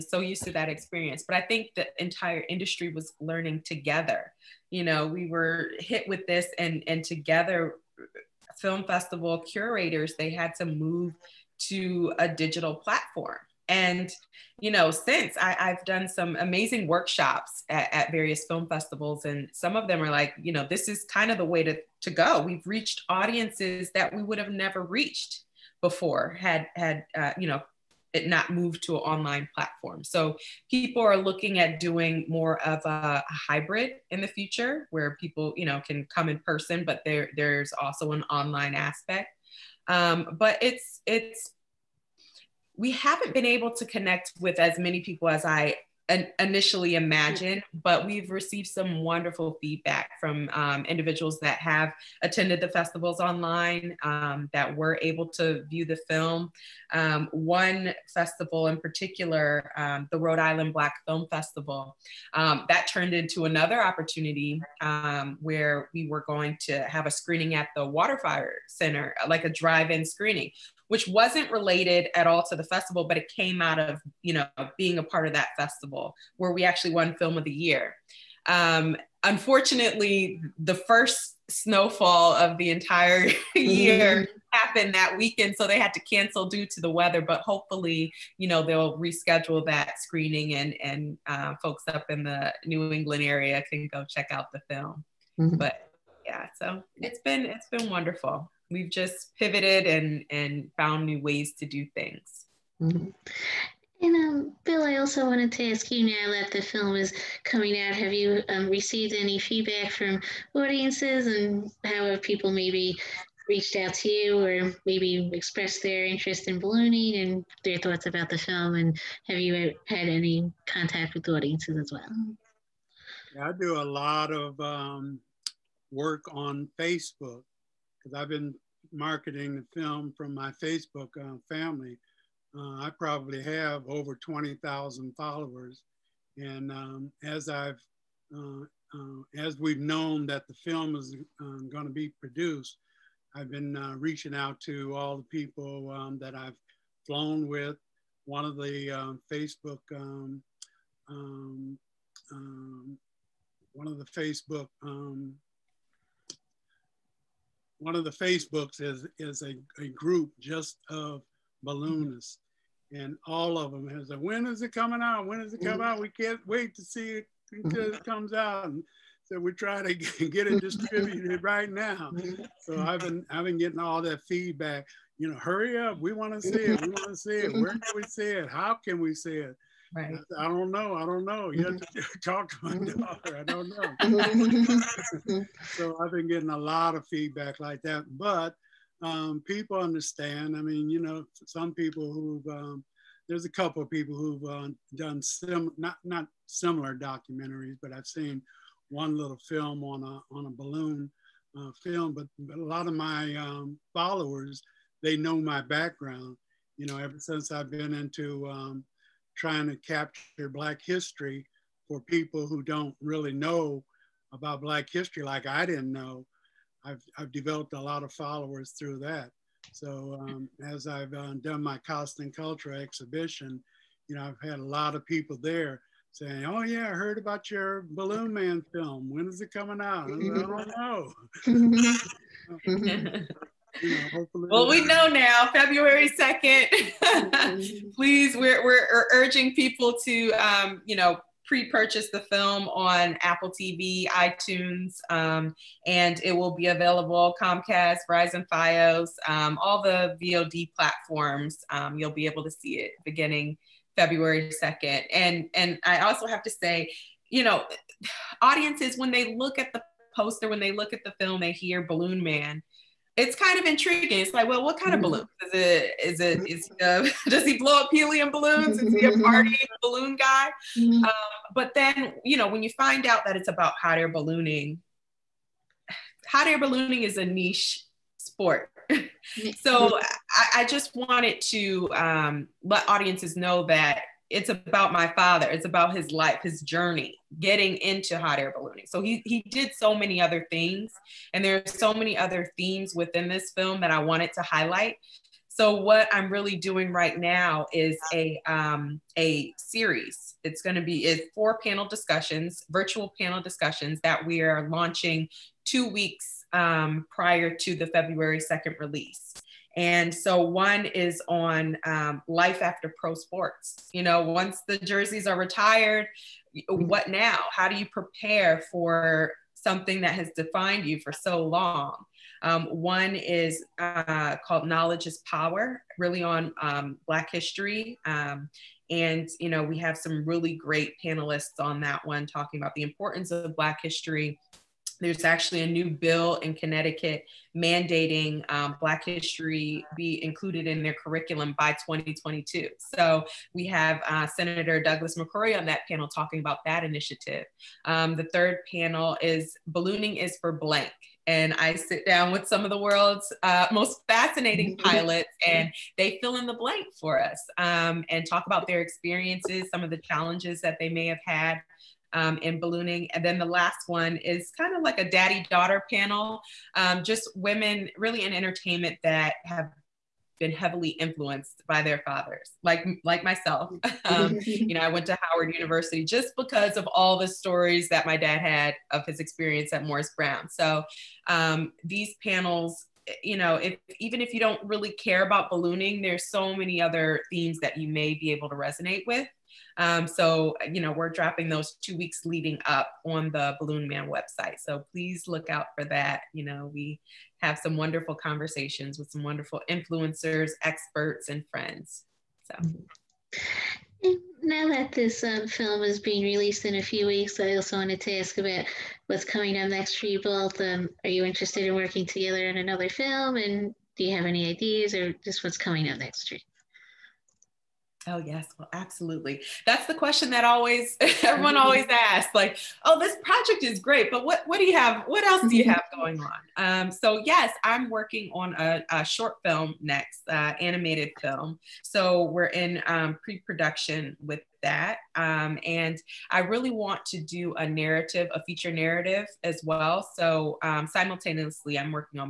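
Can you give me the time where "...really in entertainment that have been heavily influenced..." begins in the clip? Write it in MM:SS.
06:07.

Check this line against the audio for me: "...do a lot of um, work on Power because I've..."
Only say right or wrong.
wrong.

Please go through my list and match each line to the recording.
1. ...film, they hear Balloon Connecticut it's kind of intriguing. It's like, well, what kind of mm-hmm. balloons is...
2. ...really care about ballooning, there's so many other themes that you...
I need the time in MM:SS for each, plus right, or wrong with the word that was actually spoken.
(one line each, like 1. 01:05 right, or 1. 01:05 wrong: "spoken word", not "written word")
1. 04:21 wrong: "Man", not "Connecticut"
2. 06:24 right.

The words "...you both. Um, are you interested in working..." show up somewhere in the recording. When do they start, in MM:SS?
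06:50.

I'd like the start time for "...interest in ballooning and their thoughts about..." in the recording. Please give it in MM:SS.
01:56.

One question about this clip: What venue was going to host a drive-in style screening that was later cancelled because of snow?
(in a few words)
Waterfire Center.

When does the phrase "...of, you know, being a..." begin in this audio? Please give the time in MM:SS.
01:13.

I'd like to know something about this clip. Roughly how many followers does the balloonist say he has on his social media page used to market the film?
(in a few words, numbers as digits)
20,000.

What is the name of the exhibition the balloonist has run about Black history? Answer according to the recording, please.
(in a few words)
Costen Culture.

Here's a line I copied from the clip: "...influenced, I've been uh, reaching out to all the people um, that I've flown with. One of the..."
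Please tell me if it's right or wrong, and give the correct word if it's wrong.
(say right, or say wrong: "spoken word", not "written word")
wrong: "produced", not "influenced".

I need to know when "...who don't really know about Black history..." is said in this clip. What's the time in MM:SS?
03:32.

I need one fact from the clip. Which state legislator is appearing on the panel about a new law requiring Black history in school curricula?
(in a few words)
Douglas McCrory.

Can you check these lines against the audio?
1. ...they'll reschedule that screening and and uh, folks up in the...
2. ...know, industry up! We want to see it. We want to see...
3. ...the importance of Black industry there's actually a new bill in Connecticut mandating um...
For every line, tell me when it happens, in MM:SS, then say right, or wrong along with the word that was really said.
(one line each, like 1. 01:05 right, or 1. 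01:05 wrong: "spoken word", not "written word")
1. 01:28 right
2. 02:55 wrong: "hurry", not "industry"
3. 05:32 wrong: "history", not "industry".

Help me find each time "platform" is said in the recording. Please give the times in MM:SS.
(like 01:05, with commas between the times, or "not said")
00:12, 00:29, 04:10.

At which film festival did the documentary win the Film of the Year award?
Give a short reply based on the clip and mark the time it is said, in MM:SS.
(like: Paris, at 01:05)
Rhode Island Black Film Festival, at 01:00.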